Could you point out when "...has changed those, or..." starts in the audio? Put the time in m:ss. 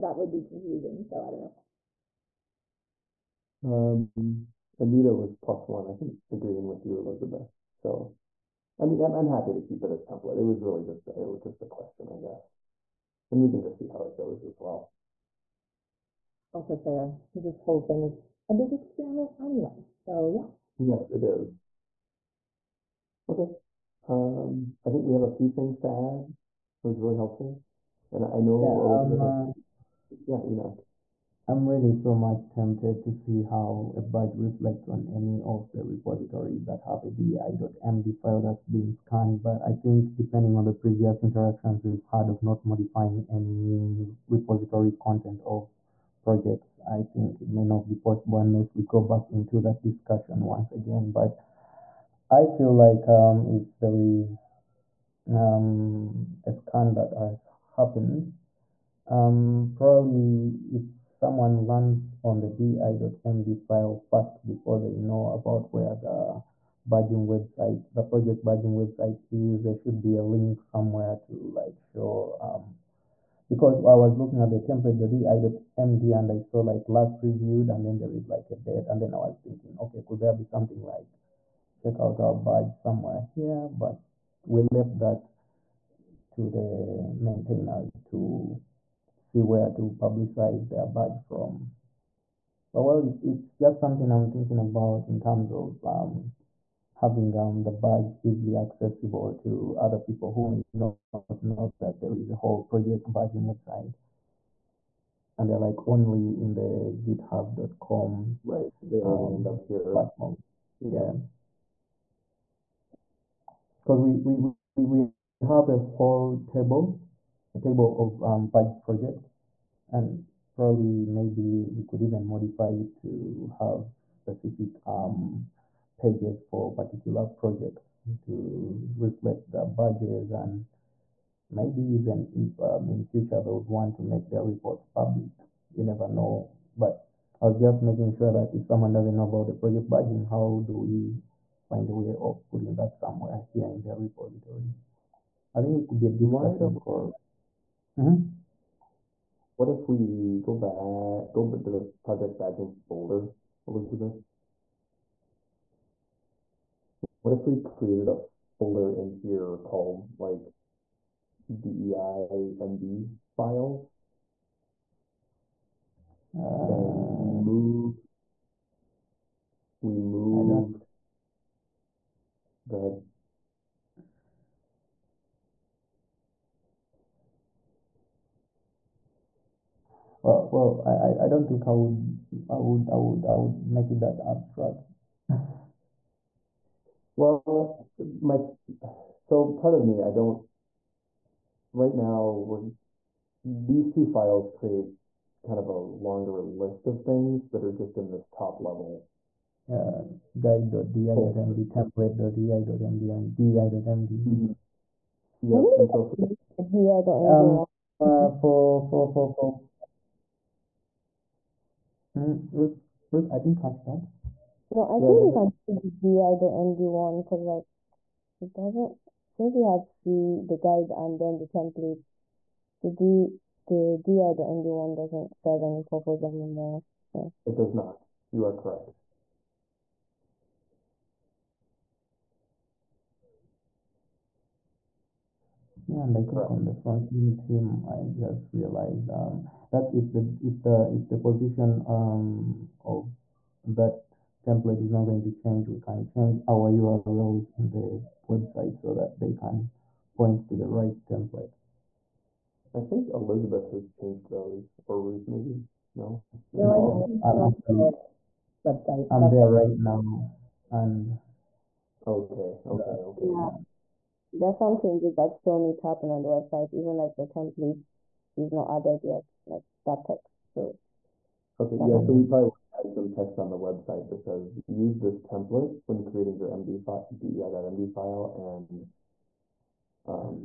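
4:13.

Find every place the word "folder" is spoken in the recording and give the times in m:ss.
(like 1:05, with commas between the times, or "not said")
2:32, 2:38.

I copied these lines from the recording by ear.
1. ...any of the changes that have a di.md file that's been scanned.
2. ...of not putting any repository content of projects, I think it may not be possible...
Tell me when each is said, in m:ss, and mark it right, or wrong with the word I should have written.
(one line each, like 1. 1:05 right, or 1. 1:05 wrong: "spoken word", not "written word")
1. 0:35 wrong: "repositories", not "changes"
2. 0:42 wrong: "modifying", not "putting".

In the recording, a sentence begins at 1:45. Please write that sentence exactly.
And they're like only in the github.com.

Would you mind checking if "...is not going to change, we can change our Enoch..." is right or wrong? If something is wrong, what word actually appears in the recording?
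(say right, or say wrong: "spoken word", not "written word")
wrong: "URLs", not "Enoch".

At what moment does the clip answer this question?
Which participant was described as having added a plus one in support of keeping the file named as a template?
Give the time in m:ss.
0:04.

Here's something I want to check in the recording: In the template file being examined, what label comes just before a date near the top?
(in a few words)
last reviewed.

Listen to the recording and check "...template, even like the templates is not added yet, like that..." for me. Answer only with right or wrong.
wrong.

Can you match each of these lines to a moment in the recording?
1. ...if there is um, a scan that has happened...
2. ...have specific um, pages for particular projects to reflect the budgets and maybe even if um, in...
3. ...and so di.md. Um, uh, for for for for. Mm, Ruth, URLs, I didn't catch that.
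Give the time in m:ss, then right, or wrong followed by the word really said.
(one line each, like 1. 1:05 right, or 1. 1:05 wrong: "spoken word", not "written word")
1. 0:53 right
2. 2:03 right
3. 3:25 wrong: "Ruth", not "URLs".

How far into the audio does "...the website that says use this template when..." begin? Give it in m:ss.
4:33.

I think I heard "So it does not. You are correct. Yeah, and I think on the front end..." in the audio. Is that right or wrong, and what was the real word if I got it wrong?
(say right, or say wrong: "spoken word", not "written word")
right.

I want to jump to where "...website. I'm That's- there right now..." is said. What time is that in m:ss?
4:18.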